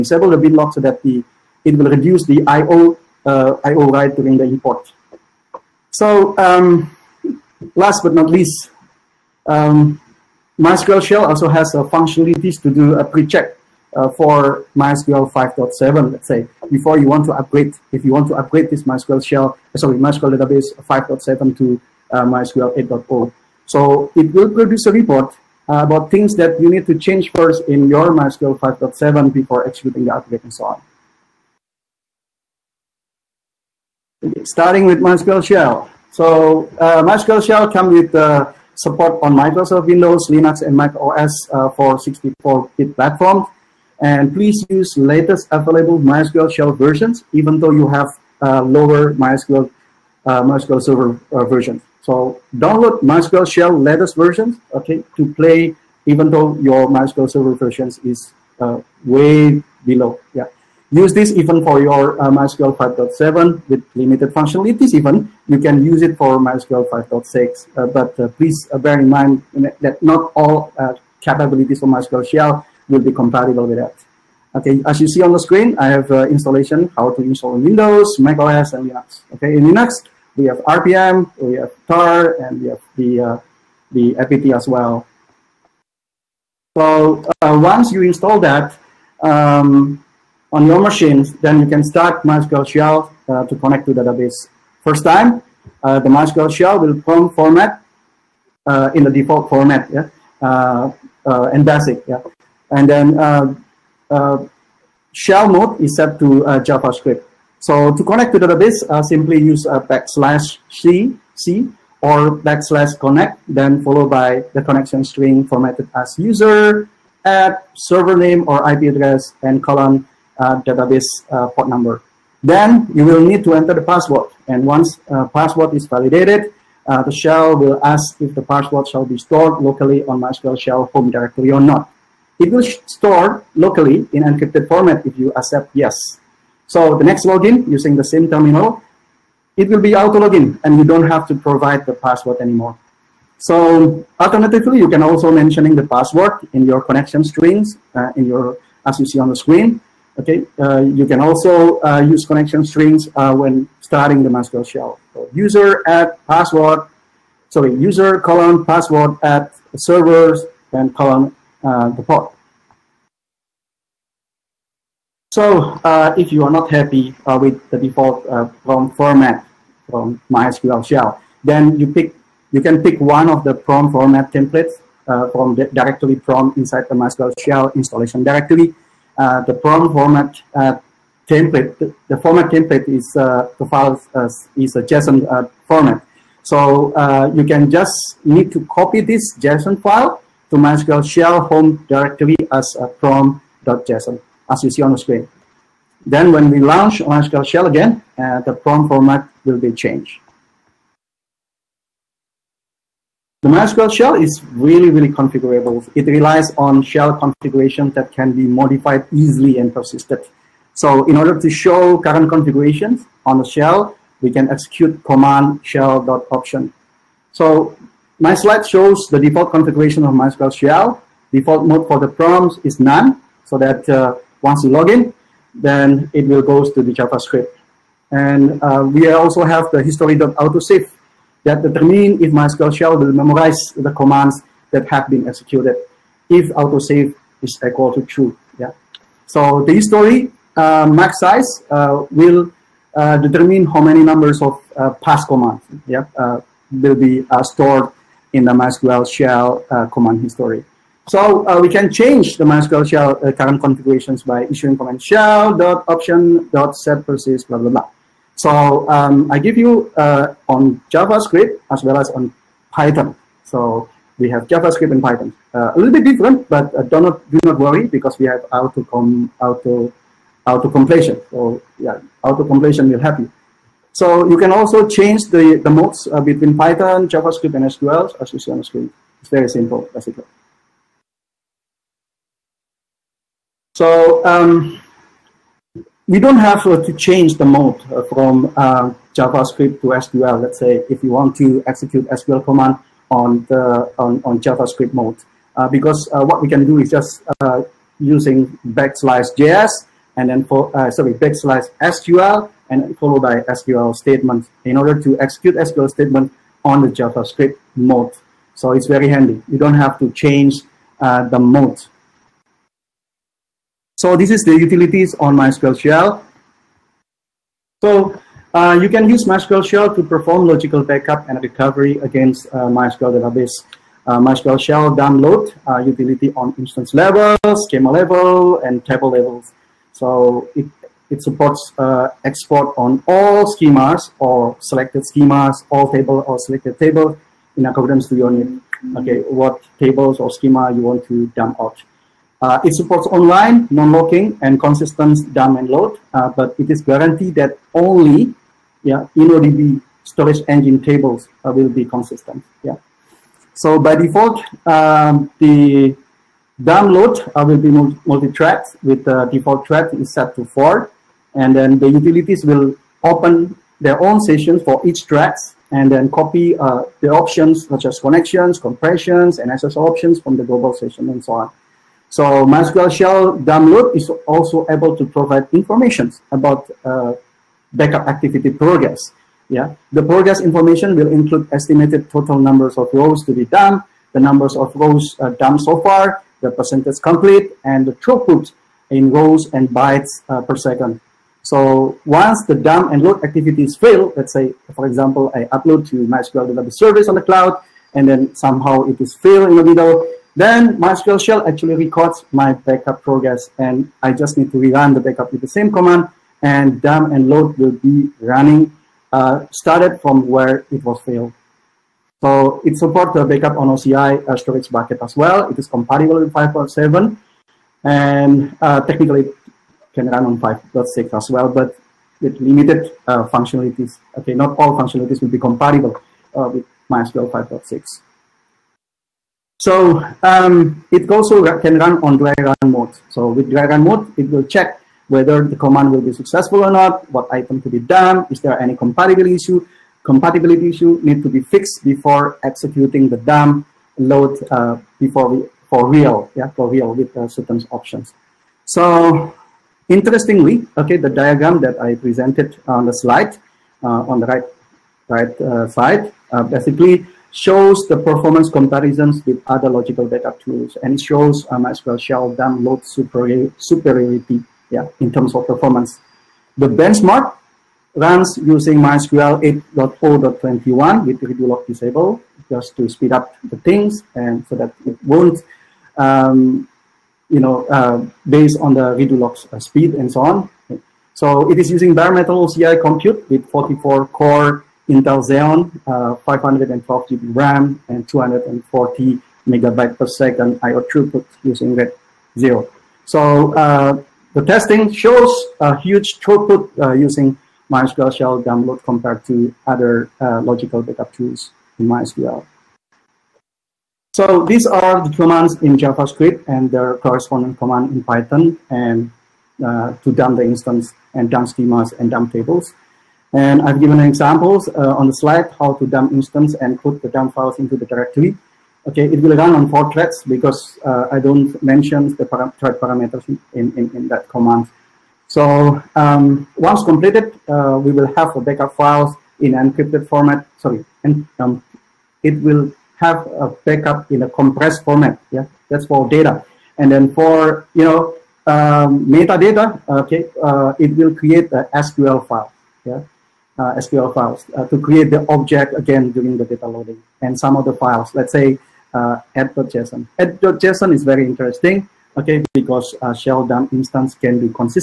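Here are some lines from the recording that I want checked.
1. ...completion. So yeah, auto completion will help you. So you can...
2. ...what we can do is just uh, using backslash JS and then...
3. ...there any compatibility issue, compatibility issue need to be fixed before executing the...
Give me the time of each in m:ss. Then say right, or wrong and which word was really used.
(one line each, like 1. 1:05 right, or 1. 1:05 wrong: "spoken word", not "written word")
1. 4:30 right
2. 4:56 right
3. 7:18 right.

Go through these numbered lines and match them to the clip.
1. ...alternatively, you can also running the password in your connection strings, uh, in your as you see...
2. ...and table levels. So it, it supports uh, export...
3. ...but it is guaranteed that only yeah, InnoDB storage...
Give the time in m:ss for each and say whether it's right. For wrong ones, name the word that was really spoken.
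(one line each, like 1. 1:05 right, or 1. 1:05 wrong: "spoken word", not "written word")
1. 2:24 wrong: "mentioning", not "running"
2. 5:28 right
3. 5:46 right.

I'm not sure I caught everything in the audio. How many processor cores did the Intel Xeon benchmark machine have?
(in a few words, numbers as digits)
44.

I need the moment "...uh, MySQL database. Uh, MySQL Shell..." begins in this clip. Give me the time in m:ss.
5:22.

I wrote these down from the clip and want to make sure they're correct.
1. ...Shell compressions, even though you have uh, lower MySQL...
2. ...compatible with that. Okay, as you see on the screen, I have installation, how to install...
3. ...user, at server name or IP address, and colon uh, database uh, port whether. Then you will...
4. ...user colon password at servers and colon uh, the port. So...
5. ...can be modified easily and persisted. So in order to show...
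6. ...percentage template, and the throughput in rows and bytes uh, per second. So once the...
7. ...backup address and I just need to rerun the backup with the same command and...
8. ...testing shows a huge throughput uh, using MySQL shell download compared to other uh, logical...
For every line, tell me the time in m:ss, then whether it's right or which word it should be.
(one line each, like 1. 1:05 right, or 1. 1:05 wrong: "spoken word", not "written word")
1. 0:46 wrong: "versions", not "compressions"
2. 1:13 right
3. 1:56 wrong: "number", not "whether"
4. 2:37 right
5. 3:28 right
6. 6:26 wrong: "complete", not "template"
7. 6:42 wrong: "progress", not "address"
8. 8:14 right.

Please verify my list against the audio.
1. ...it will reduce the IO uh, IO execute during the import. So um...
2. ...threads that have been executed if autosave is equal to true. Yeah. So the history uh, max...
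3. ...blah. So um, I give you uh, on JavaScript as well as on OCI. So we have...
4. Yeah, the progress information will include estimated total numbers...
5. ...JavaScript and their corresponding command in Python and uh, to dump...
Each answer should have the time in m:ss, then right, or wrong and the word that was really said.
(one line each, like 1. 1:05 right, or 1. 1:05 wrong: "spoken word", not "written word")
1. 0:01 wrong: "write", not "execute"
2. 3:53 wrong: "commands", not "threads"
3. 4:17 wrong: "Python", not "OCI"
4. 6:19 right
5. 8:25 right.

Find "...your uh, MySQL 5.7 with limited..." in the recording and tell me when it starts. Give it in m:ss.
1:01.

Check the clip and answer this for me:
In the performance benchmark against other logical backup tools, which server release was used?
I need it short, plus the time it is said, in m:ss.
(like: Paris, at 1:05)
MySQL 8.0.21, at 7:48.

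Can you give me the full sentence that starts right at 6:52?
So it supports the backup on OCI uh, storage bucket as well.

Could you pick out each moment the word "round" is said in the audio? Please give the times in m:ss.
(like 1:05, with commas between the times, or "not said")
not said.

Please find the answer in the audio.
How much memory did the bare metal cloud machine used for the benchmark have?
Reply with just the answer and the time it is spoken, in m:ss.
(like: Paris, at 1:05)
512 GB, at 8:06.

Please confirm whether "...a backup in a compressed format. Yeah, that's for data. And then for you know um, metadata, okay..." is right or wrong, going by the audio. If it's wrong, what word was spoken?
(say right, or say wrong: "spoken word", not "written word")
right.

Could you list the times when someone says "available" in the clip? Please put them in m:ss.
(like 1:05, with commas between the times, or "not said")
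0:45.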